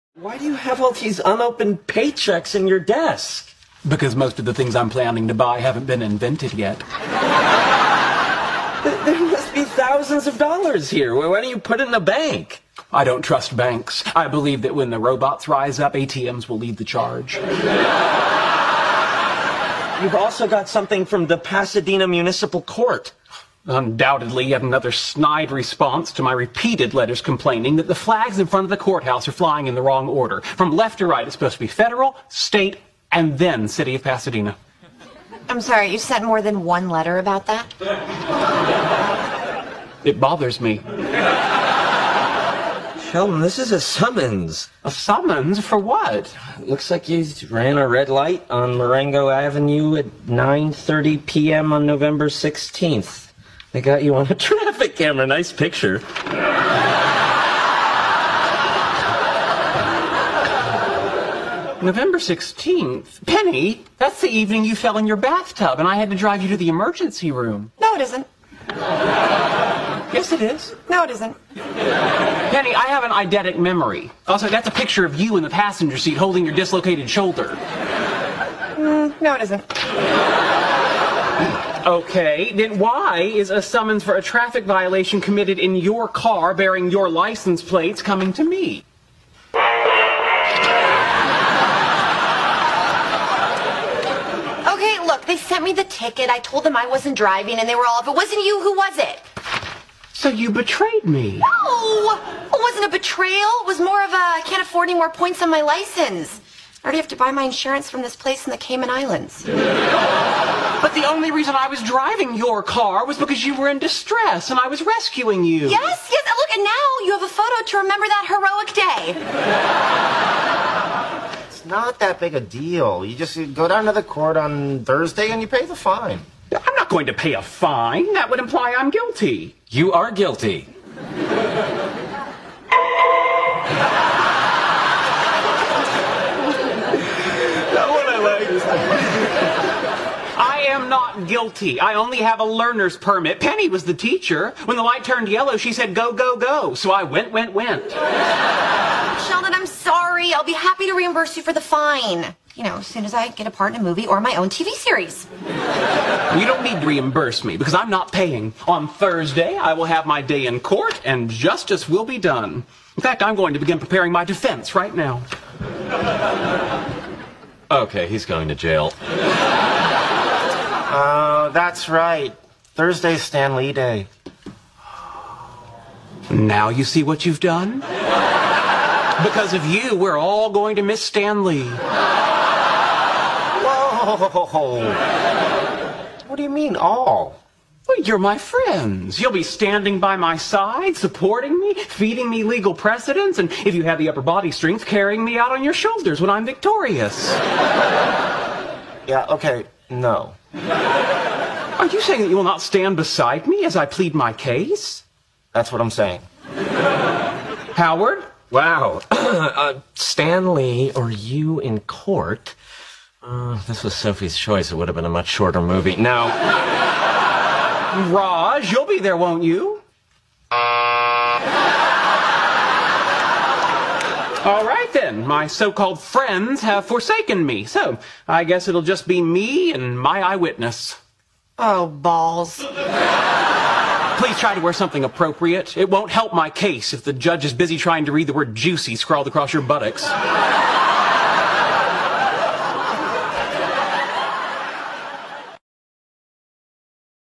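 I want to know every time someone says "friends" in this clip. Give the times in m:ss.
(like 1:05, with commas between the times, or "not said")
3:08, 3:45.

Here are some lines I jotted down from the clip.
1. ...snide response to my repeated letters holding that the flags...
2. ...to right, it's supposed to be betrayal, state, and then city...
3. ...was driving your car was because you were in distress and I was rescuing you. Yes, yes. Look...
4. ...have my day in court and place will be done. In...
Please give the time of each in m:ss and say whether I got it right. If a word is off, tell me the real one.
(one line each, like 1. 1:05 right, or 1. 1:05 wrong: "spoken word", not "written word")
1. 0:24 wrong: "complaining", not "holding"
2. 0:30 wrong: "federal", not "betrayal"
3. 1:51 right
4. 2:39 wrong: "justice", not "place".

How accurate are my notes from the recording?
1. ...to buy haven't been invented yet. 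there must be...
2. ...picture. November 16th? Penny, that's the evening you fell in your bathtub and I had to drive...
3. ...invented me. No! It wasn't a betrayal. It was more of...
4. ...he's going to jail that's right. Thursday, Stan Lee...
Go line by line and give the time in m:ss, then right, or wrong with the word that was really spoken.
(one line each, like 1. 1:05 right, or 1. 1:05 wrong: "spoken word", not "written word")
1. 0:05 right
2. 0:55 right
3. 1:40 wrong: "betrayed", not "invented"
4. 2:48 right.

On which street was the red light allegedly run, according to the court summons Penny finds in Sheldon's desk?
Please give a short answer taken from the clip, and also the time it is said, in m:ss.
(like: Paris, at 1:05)
Marengo Avenue, at 0:48.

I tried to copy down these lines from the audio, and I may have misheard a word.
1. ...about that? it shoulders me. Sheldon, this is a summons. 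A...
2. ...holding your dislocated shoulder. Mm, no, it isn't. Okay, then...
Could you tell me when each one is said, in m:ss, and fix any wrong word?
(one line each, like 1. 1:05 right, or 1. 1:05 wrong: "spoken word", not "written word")
1. 0:37 wrong: "bothers", not "shoulders"
2. 1:16 right.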